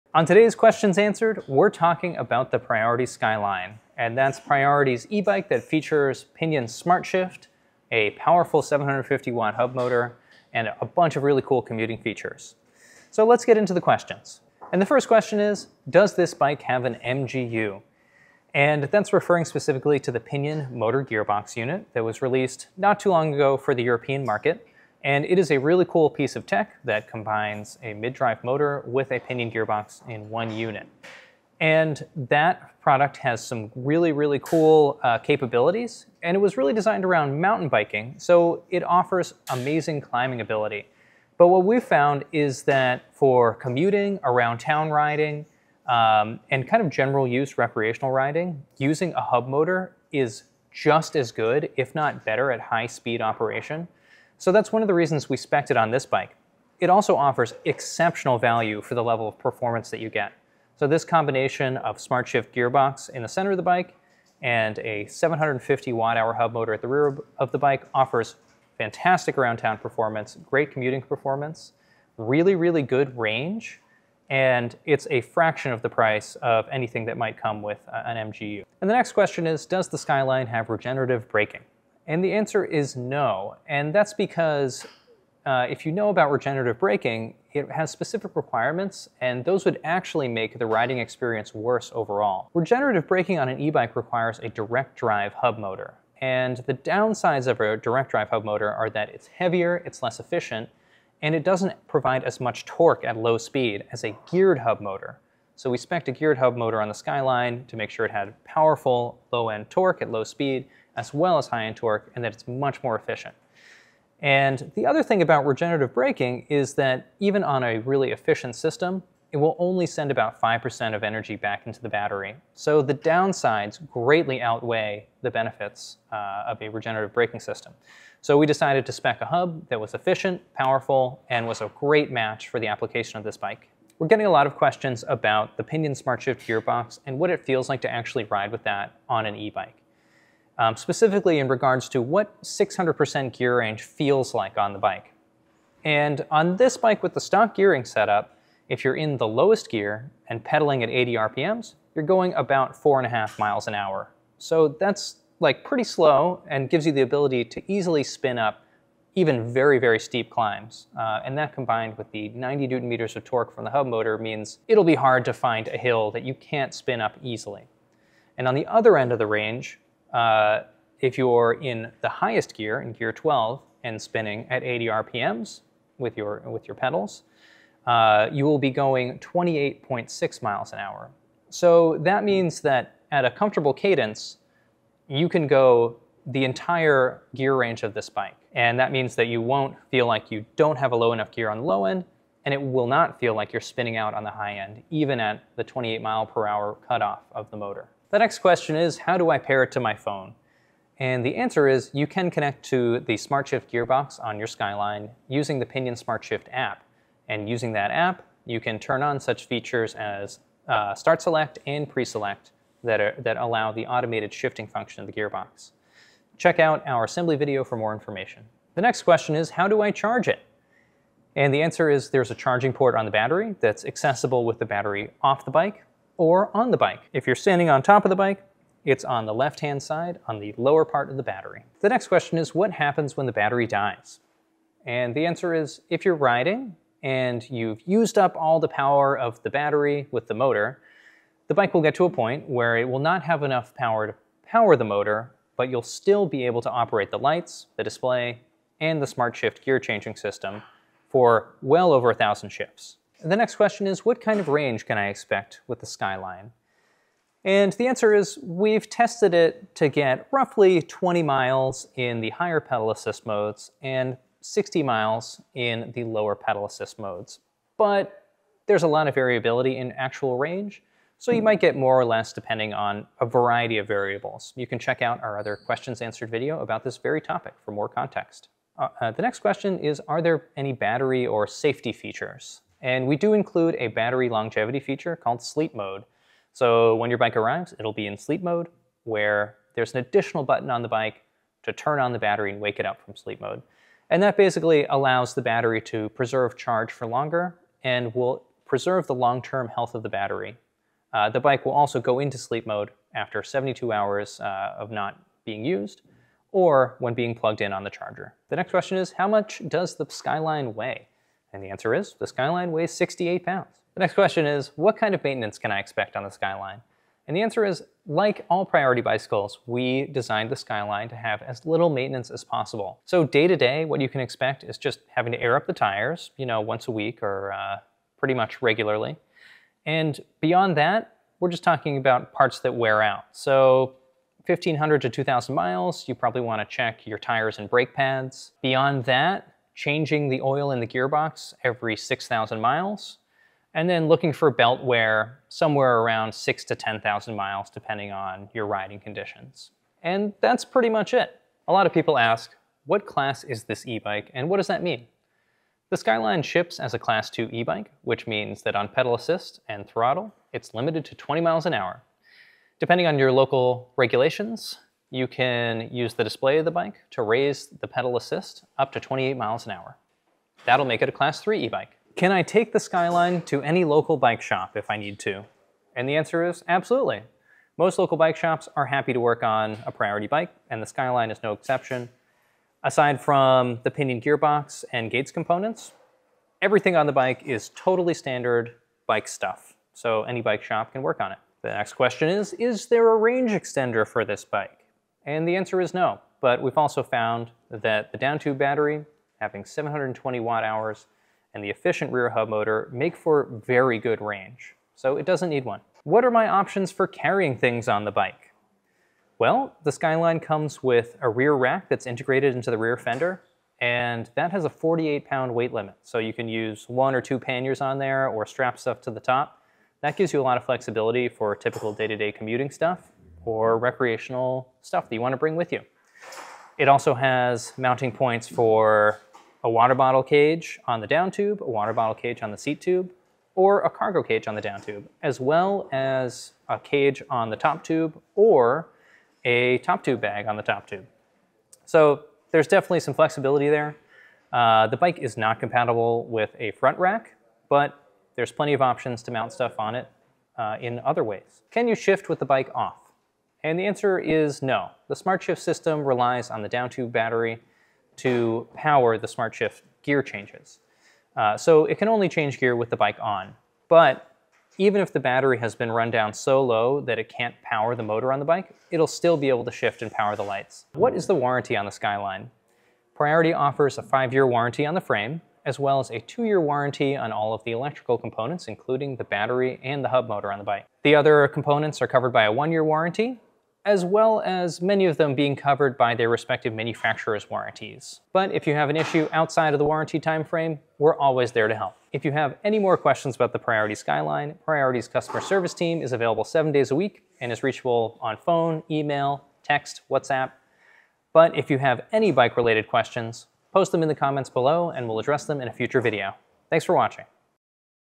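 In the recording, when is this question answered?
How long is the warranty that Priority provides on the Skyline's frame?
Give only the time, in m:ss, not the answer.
7:54.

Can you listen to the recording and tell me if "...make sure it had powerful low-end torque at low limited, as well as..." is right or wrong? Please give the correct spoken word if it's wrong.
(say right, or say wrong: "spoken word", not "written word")
wrong: "speed", not "limited".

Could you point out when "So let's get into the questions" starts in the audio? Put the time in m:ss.
0:13.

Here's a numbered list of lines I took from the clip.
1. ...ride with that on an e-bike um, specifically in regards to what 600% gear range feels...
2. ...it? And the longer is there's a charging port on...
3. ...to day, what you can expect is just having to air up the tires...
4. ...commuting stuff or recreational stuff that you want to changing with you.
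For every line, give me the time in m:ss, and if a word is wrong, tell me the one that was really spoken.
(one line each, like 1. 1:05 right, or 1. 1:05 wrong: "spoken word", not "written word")
1. 2:18 right
2. 3:40 wrong: "answer", not "longer"
3. 5:23 right
4. 7:02 wrong: "bring", not "changing".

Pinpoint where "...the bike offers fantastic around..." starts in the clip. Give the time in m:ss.
1:07.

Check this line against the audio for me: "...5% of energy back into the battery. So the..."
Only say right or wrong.
right.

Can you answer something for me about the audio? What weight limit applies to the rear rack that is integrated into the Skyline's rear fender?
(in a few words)
48 pounds.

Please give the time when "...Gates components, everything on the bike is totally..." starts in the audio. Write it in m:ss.
6:25.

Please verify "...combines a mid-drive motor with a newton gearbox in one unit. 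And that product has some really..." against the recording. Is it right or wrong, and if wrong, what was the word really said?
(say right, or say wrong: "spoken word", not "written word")
wrong: "pinion", not "newton".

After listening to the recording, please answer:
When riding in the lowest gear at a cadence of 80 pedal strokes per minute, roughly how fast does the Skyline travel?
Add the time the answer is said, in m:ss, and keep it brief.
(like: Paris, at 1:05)
4.5 miles an hour, at 2:32.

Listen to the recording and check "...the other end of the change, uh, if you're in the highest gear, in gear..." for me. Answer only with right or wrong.
wrong.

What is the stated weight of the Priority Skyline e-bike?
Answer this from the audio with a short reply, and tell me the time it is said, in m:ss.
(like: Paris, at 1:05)
68 pounds, at 5:12.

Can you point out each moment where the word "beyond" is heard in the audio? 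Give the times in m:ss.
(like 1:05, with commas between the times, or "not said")
5:30, 5:38.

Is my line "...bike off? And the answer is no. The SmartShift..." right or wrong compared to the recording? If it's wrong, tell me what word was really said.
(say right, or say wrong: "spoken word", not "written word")
right.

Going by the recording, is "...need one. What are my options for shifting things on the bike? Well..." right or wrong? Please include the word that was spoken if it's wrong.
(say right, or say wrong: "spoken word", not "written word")
wrong: "carrying", not "shifting".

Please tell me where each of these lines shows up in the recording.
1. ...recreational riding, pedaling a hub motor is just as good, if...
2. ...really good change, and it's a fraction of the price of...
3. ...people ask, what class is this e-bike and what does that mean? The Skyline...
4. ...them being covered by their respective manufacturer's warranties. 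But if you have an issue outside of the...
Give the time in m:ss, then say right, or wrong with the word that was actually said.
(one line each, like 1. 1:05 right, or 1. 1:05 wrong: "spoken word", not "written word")
1. 0:47 wrong: "using", not "pedaling"
2. 1:12 wrong: "range", not "change"
3. 5:51 right
4. 8:05 right.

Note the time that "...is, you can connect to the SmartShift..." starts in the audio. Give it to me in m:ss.
3:21.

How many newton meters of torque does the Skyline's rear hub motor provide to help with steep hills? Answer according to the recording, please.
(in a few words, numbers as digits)
90.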